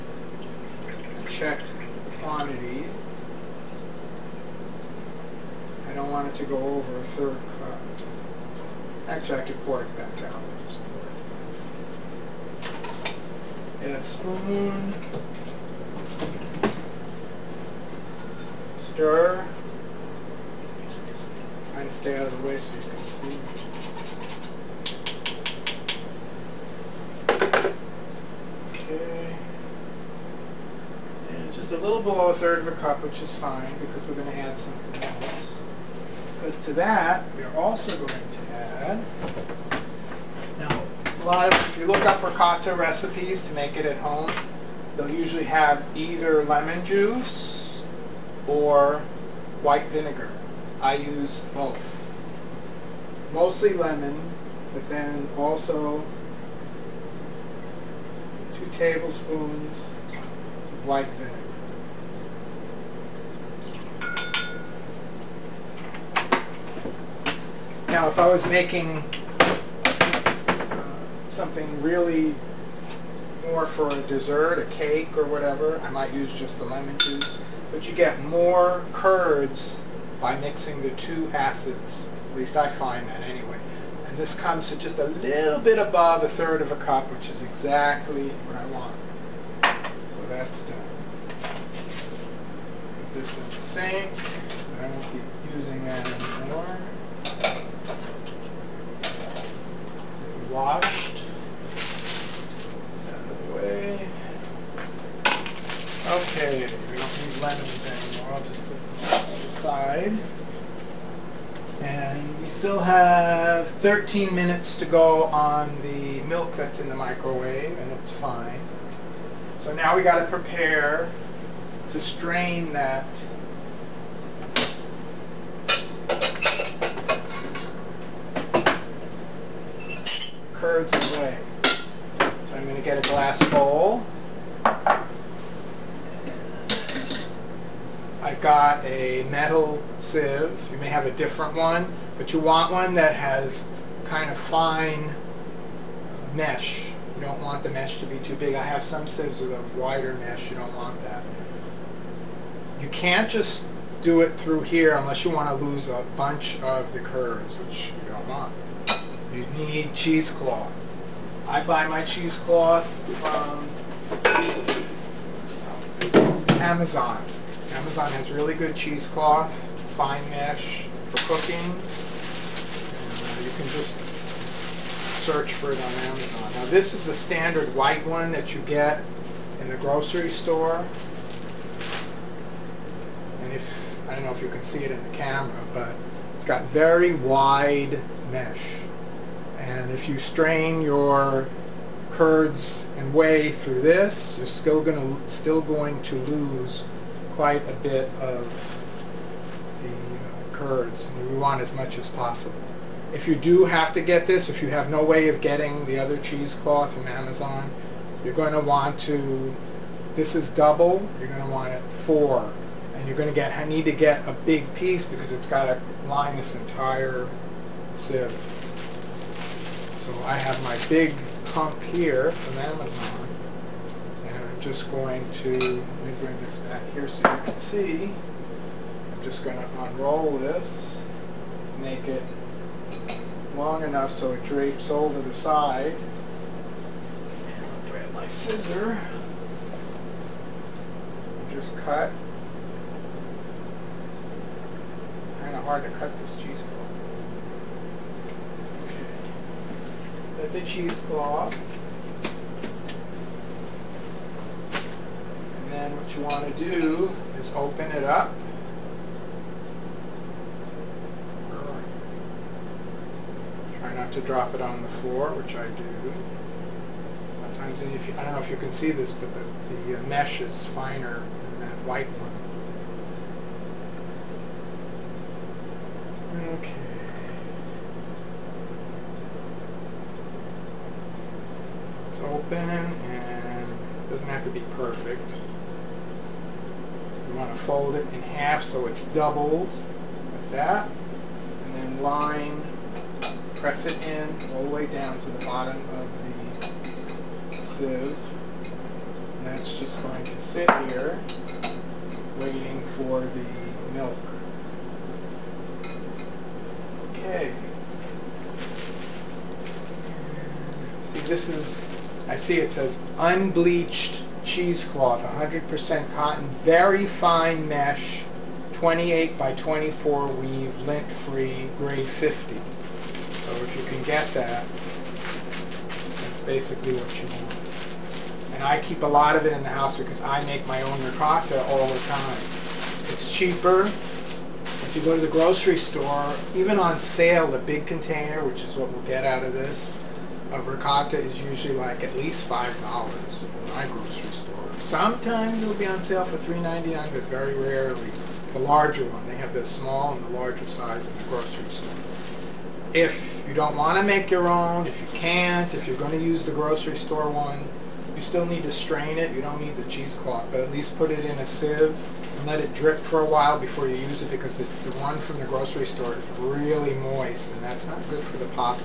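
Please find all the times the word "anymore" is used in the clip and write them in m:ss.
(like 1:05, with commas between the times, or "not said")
1:36, 1:48.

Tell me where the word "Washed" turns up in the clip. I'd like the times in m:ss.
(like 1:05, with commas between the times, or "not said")
1:40.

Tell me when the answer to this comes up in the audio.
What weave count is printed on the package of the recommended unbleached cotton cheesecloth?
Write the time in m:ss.
5:18.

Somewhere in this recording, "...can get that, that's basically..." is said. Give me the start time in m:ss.
5:23.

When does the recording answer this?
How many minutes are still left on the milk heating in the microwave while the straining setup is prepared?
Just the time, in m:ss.
1:53.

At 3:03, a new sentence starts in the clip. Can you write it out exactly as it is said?
And if, I don't know if you can see it in the camera, but it's got very wide mesh.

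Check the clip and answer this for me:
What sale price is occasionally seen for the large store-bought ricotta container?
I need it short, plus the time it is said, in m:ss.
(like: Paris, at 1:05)
$3.99, at 5:46.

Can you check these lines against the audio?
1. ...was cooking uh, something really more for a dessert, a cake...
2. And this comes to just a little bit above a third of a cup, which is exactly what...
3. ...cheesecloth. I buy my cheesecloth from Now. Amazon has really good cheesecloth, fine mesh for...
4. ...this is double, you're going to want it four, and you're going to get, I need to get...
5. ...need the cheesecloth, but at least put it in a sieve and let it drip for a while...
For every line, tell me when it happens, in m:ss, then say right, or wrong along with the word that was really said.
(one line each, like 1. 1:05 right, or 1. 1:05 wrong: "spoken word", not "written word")
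1. 1:08 wrong: "making", not "cooking"
2. 1:24 right
3. 2:39 wrong: "Amazon", not "Now"
4. 3:30 right
5. 5:59 right.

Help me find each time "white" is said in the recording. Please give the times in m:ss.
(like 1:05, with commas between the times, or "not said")
0:49, 1:00, 2:57, 4:31.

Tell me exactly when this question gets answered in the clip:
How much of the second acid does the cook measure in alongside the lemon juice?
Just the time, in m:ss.
0:58.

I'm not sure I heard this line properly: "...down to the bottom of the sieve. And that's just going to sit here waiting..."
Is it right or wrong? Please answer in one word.
right.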